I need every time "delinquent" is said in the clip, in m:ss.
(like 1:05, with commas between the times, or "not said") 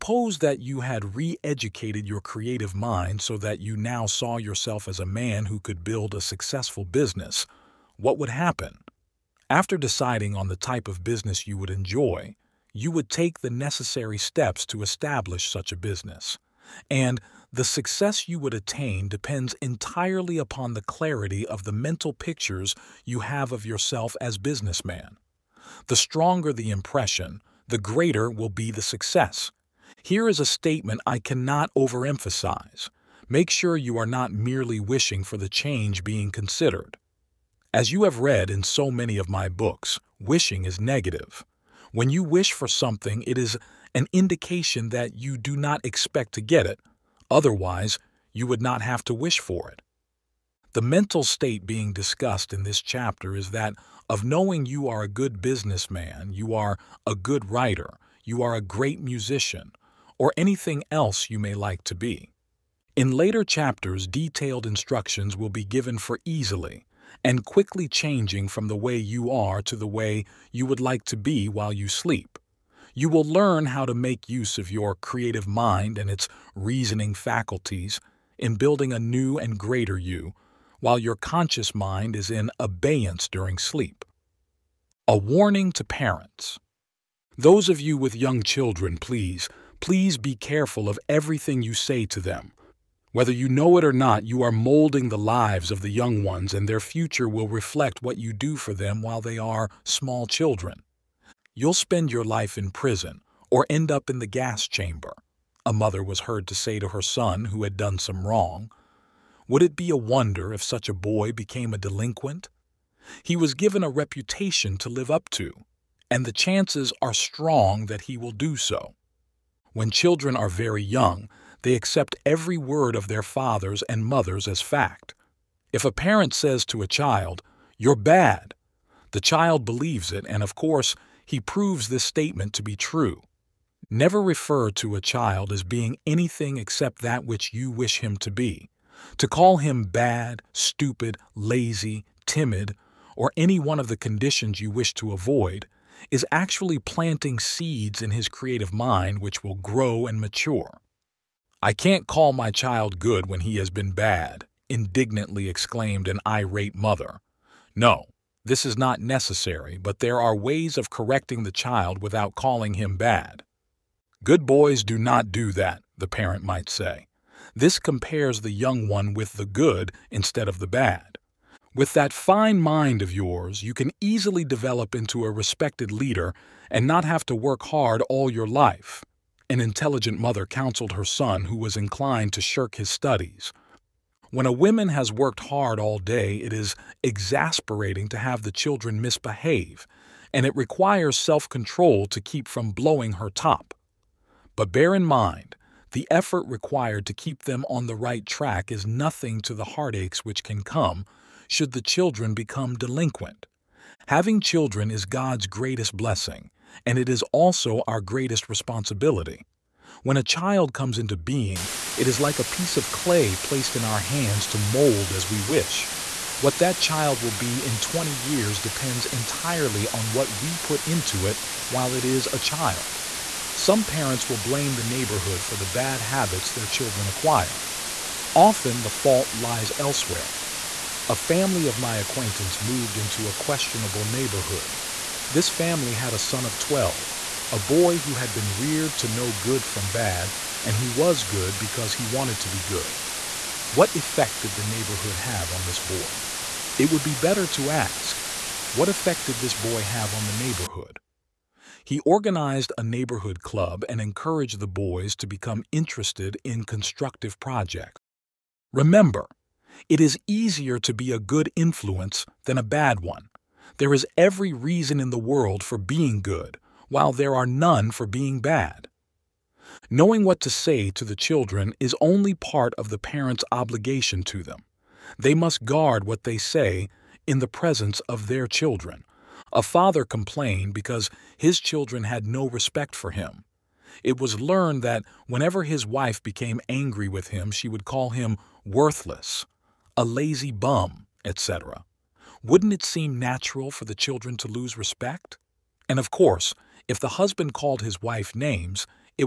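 1:51, 3:22.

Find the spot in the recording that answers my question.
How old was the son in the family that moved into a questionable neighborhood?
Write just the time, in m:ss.
3:56.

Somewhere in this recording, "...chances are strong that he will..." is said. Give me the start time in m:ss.
1:56.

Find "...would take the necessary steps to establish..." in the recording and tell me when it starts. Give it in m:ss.
0:12.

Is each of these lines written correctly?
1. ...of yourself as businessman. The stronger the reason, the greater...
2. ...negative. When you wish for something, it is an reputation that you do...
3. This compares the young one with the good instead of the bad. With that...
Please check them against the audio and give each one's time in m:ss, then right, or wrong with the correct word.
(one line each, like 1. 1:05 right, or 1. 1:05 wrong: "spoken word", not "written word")
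1. 0:23 wrong: "impression", not "reason"
2. 0:40 wrong: "indication", not "reputation"
3. 2:47 right.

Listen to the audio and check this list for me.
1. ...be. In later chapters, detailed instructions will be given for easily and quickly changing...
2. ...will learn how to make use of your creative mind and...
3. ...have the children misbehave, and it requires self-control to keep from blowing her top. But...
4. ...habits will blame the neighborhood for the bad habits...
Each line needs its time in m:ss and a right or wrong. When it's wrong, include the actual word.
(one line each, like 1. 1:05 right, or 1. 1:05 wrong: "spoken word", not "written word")
1. 1:01 right
2. 1:13 right
3. 3:08 right
4. 3:43 wrong: "parents", not "habits".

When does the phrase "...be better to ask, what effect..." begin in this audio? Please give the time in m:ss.
4:07.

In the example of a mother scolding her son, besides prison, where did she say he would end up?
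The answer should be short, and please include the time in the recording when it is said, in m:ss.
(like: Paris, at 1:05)
The gas chamber, at 1:44.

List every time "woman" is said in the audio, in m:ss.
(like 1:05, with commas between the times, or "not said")
3:04.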